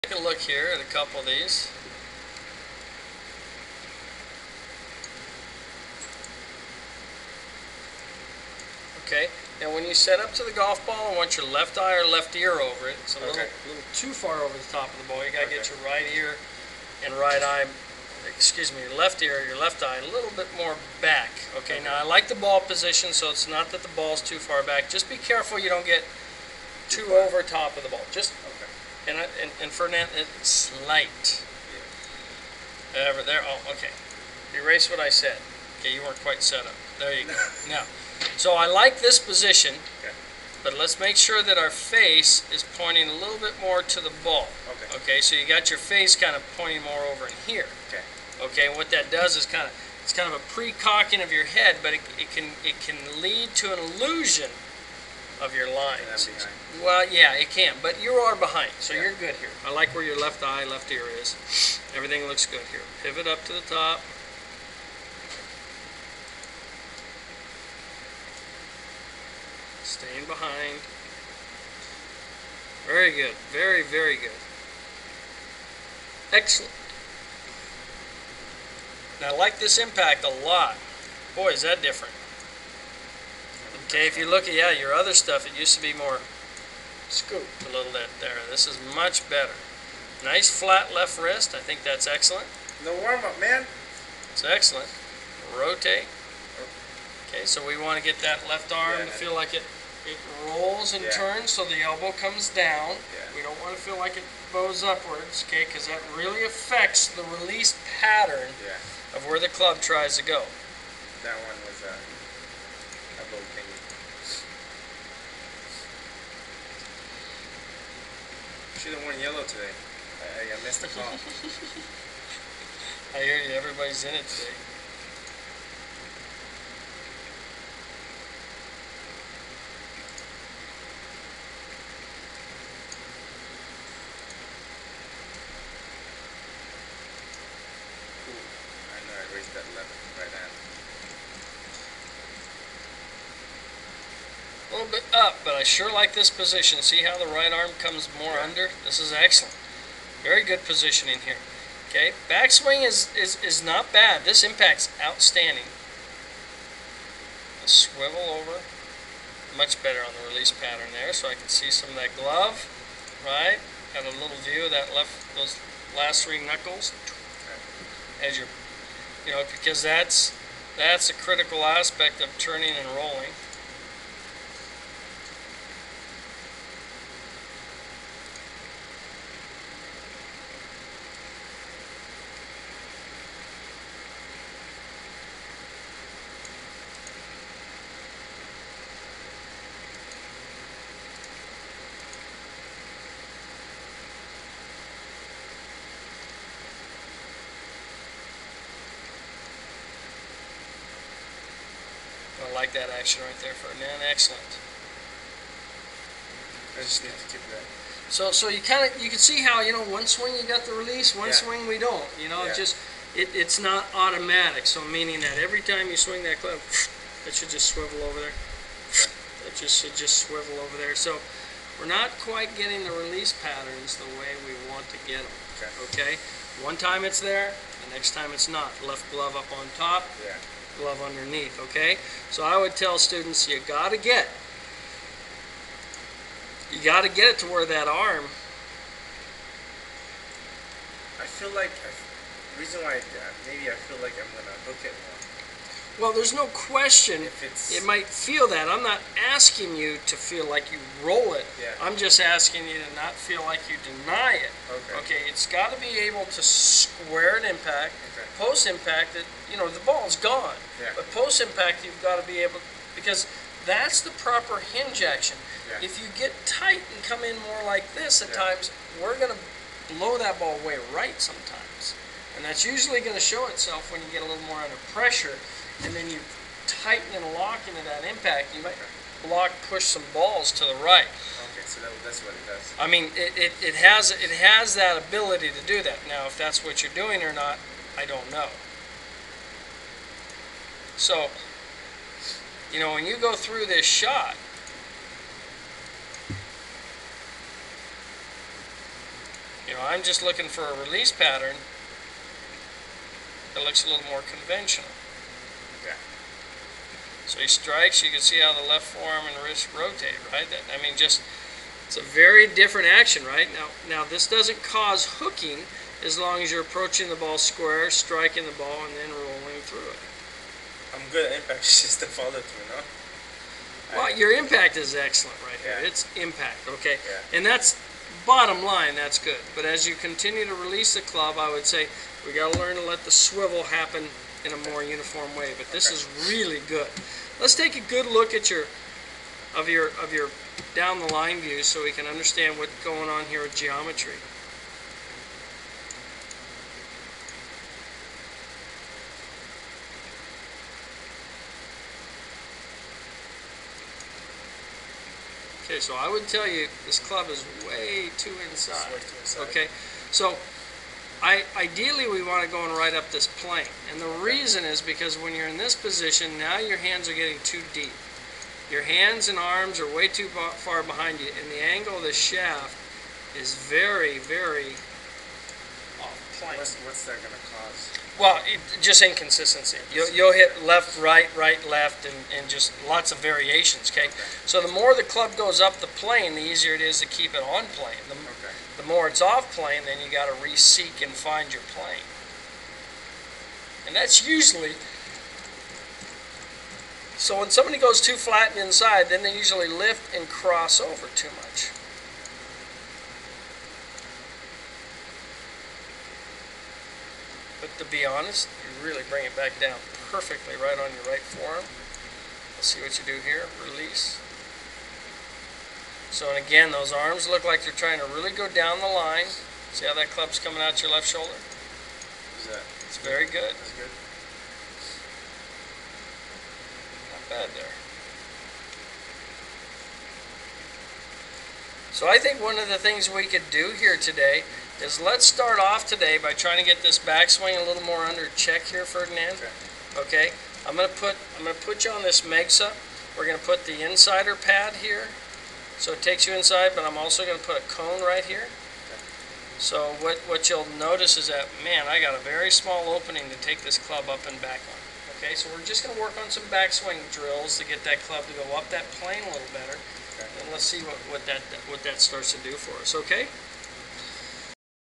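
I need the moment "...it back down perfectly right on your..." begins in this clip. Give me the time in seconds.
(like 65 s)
409 s.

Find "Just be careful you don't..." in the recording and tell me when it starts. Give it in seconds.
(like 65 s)
24 s.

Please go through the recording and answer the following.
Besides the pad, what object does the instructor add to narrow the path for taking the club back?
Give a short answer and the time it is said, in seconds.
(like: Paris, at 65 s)
A cone, at 447 s.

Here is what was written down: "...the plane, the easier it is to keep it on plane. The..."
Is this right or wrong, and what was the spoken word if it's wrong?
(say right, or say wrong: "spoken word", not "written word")
right.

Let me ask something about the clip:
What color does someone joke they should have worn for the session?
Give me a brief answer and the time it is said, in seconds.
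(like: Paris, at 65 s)
Yellow, at 119 s.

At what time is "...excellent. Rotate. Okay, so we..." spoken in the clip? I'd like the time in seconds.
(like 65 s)
94 s.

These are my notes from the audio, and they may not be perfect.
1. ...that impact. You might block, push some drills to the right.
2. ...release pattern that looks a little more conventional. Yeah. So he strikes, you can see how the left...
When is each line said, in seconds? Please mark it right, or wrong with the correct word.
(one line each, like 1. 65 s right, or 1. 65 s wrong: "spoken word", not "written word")
1. 277 s wrong: "balls", not "drills"
2. 300 s right.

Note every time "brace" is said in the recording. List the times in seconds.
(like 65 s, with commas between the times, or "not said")
not said.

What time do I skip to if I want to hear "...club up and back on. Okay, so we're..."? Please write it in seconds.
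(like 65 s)
453 s.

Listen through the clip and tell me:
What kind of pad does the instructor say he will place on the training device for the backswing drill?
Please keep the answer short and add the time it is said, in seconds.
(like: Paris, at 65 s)
Insider pad, at 443 s.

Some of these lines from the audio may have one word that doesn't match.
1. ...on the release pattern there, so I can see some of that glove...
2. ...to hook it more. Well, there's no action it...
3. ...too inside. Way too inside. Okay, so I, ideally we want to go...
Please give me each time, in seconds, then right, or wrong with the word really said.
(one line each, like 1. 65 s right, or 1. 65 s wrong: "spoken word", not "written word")
1. 159 s right
2. 244 s wrong: "question", not "action"
3. 358 s right.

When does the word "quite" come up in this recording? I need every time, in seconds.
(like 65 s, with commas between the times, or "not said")
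36 s, 222 s.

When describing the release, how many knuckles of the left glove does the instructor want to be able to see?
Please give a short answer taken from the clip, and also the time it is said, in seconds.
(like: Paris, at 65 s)
Three, at 166 s.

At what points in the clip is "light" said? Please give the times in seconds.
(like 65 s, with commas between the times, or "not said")
30 s.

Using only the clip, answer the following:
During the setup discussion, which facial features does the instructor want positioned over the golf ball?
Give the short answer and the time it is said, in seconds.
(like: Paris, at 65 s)
Left eye or left ear, at 11 s.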